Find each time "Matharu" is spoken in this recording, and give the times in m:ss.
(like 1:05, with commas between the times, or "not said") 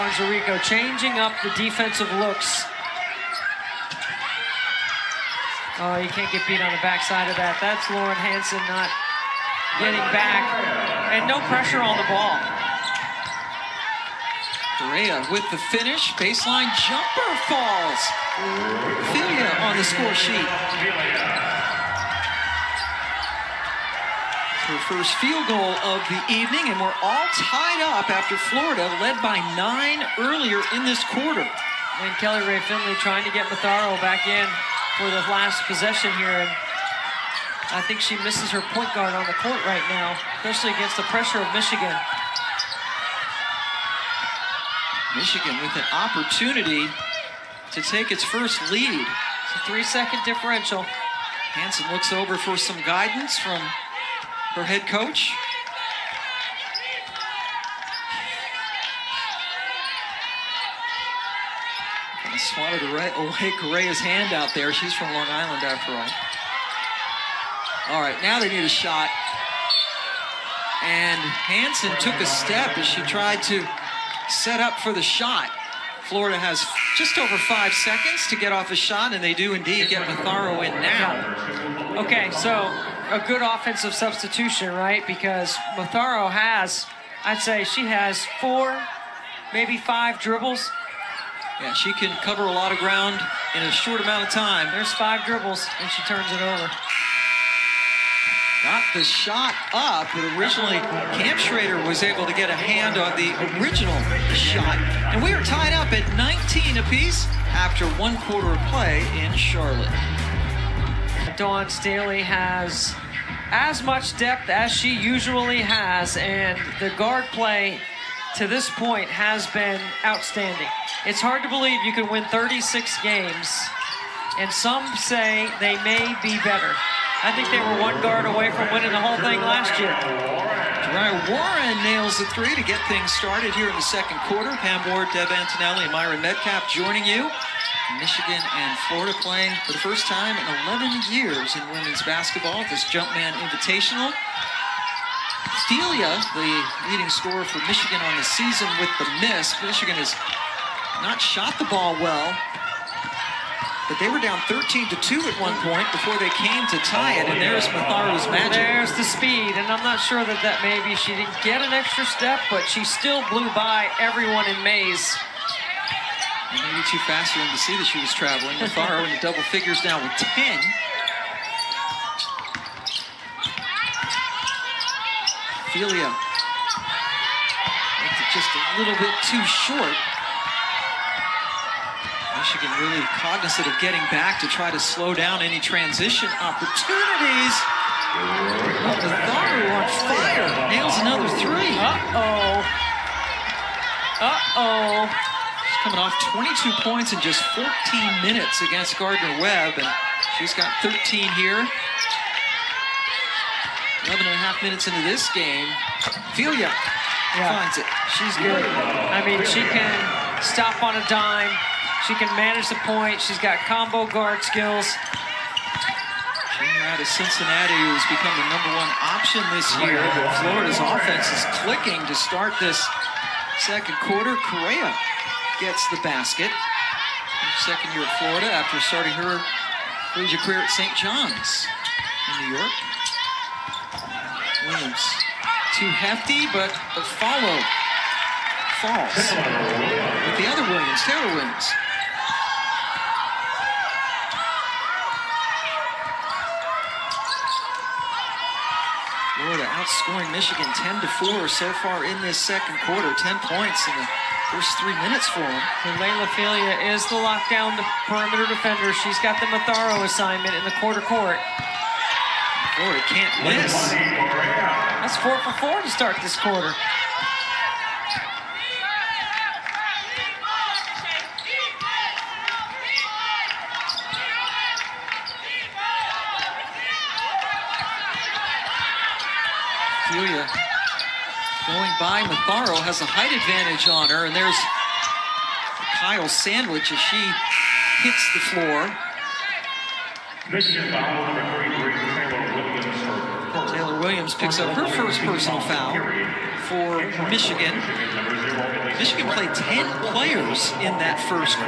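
0:33, 1:20, 1:25, 2:37, 2:48, 4:19, 4:42.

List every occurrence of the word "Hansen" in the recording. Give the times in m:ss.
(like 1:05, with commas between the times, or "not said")
0:08, 0:50, 1:11.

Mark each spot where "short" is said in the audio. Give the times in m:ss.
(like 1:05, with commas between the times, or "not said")
1:33, 2:59.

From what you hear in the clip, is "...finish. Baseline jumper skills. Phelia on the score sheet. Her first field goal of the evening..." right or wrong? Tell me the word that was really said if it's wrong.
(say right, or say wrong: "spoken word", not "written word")
wrong: "falls", not "skills".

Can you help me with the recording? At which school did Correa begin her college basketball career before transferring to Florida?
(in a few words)
St. John's.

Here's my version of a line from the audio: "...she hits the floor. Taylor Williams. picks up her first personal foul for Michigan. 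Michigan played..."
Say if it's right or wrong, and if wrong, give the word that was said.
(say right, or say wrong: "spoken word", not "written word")
right.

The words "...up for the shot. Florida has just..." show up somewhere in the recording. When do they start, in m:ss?
1:14.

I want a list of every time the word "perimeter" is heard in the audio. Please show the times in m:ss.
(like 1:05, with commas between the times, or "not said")
4:18.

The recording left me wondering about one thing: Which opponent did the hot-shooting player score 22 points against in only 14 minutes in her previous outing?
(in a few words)
Gardner-Webb.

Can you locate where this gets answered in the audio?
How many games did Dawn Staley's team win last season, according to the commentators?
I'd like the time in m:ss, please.
2:02.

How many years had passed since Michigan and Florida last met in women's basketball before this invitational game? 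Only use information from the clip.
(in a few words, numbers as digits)
11.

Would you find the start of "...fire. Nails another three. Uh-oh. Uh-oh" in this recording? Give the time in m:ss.
3:09.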